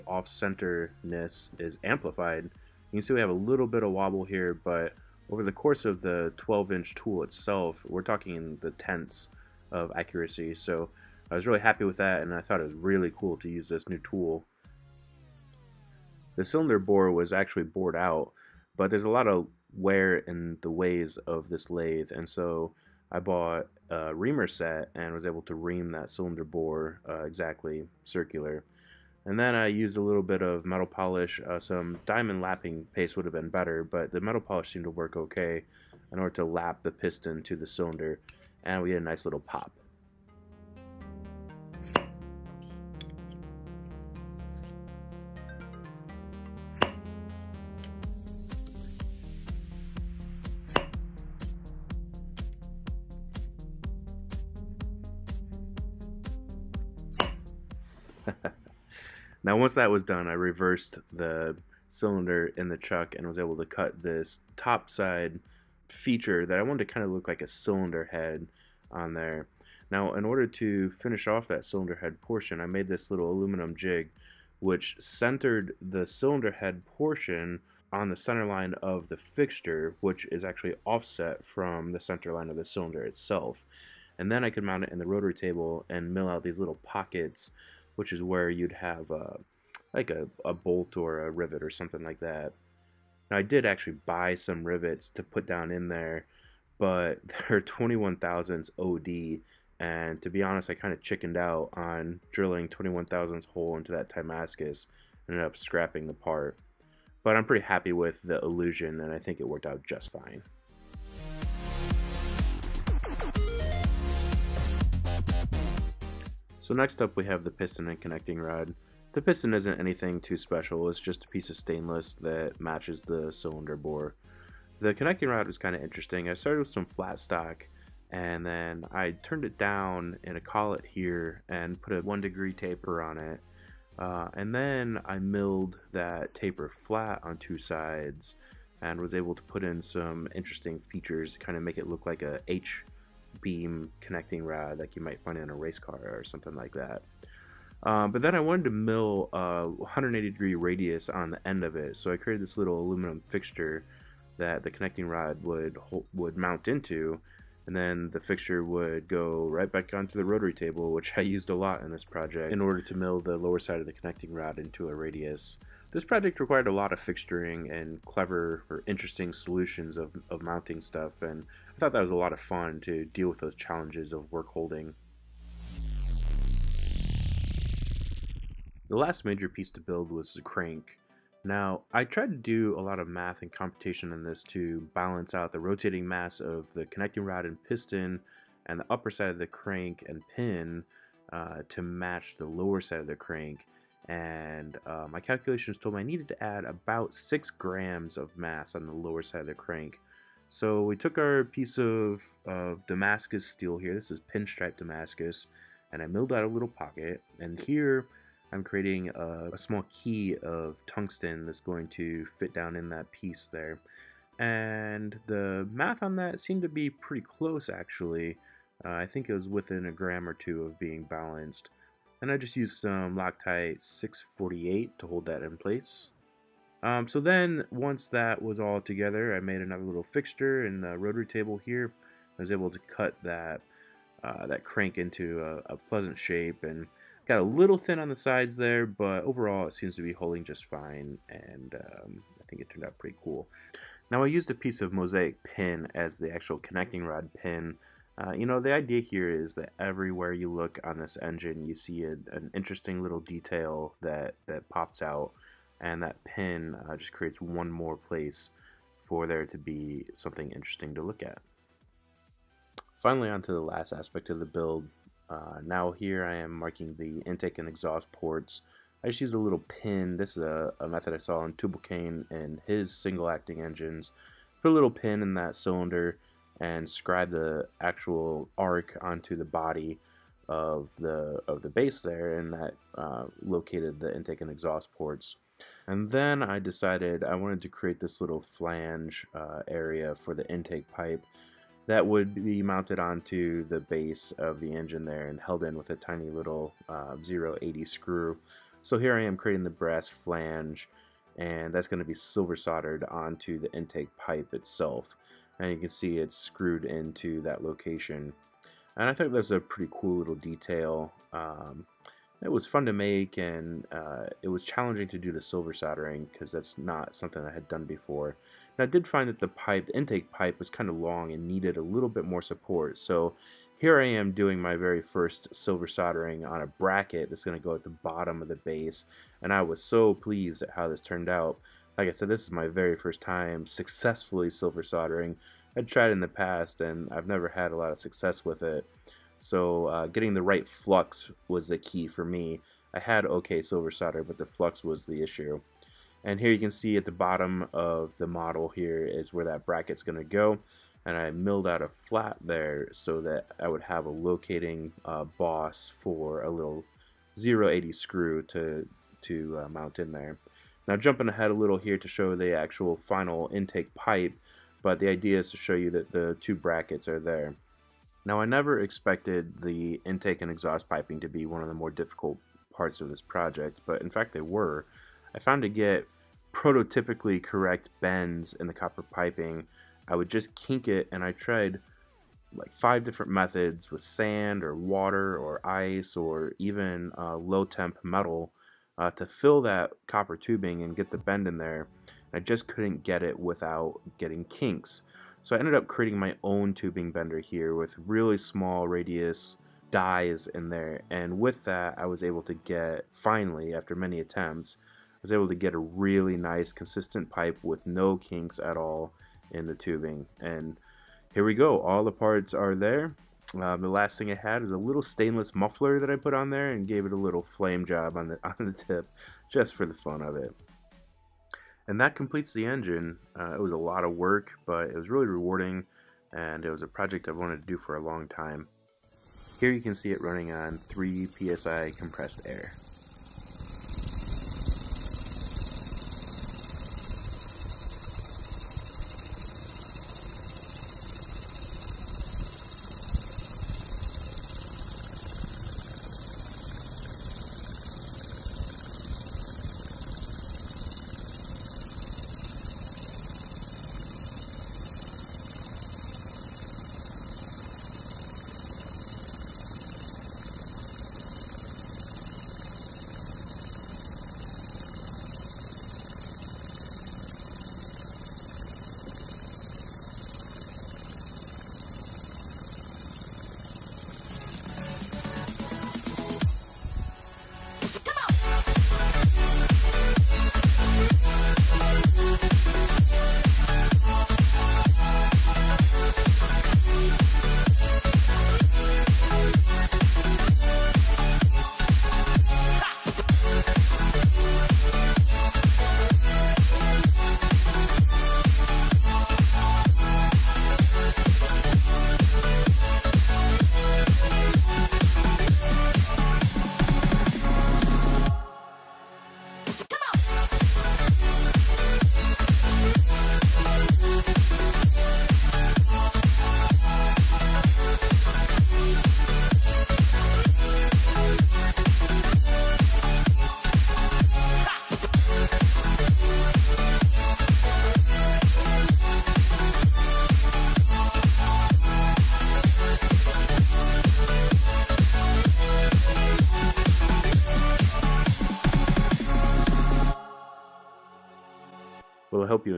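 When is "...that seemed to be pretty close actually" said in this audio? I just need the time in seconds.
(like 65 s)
216 s.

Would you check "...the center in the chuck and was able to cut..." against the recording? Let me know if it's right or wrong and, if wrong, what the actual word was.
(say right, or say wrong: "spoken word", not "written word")
wrong: "cylinder", not "center".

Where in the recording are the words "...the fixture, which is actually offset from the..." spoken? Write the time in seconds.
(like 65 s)
79 s.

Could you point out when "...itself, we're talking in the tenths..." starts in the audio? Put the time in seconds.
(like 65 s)
7 s.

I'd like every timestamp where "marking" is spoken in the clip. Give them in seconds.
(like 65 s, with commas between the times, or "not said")
266 s.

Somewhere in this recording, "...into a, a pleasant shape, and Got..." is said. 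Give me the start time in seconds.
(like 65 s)
234 s.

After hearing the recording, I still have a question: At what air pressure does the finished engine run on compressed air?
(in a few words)
3 psi.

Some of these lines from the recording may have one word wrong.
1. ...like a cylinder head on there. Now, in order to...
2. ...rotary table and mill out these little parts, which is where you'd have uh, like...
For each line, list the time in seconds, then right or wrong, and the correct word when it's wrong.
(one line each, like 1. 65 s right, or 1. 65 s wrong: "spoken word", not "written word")
1. 67 s right
2. 85 s wrong: "pockets", not "parts".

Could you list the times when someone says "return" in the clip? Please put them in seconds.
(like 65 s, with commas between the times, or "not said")
not said.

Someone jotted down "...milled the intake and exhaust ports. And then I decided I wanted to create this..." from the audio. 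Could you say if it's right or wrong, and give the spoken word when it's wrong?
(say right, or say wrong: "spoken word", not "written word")
wrong: "located", not "milled".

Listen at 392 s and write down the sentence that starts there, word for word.
I just couldn't get it without getting kinks.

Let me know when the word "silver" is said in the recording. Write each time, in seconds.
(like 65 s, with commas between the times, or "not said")
302 s, 315 s, 325 s, 334 s, 343 s.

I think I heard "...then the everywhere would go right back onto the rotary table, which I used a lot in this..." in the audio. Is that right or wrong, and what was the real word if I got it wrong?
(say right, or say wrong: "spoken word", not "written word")
wrong: "fixture", not "everywhere".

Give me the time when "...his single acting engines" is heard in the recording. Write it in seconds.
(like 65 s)
272 s.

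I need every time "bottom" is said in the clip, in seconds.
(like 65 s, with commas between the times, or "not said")
328 s, 347 s.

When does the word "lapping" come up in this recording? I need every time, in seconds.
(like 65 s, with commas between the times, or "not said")
32 s.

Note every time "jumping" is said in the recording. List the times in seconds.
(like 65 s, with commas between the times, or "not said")
360 s.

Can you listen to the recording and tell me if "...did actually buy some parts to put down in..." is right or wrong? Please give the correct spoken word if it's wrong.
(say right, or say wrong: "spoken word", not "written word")
wrong: "rivets", not "parts".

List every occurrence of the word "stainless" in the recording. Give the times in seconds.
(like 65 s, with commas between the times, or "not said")
121 s, 415 s.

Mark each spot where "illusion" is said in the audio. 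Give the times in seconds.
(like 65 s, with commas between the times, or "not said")
108 s.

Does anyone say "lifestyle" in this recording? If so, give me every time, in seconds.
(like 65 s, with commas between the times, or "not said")
not said.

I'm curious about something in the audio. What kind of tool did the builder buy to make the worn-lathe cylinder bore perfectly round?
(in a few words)
reamer set.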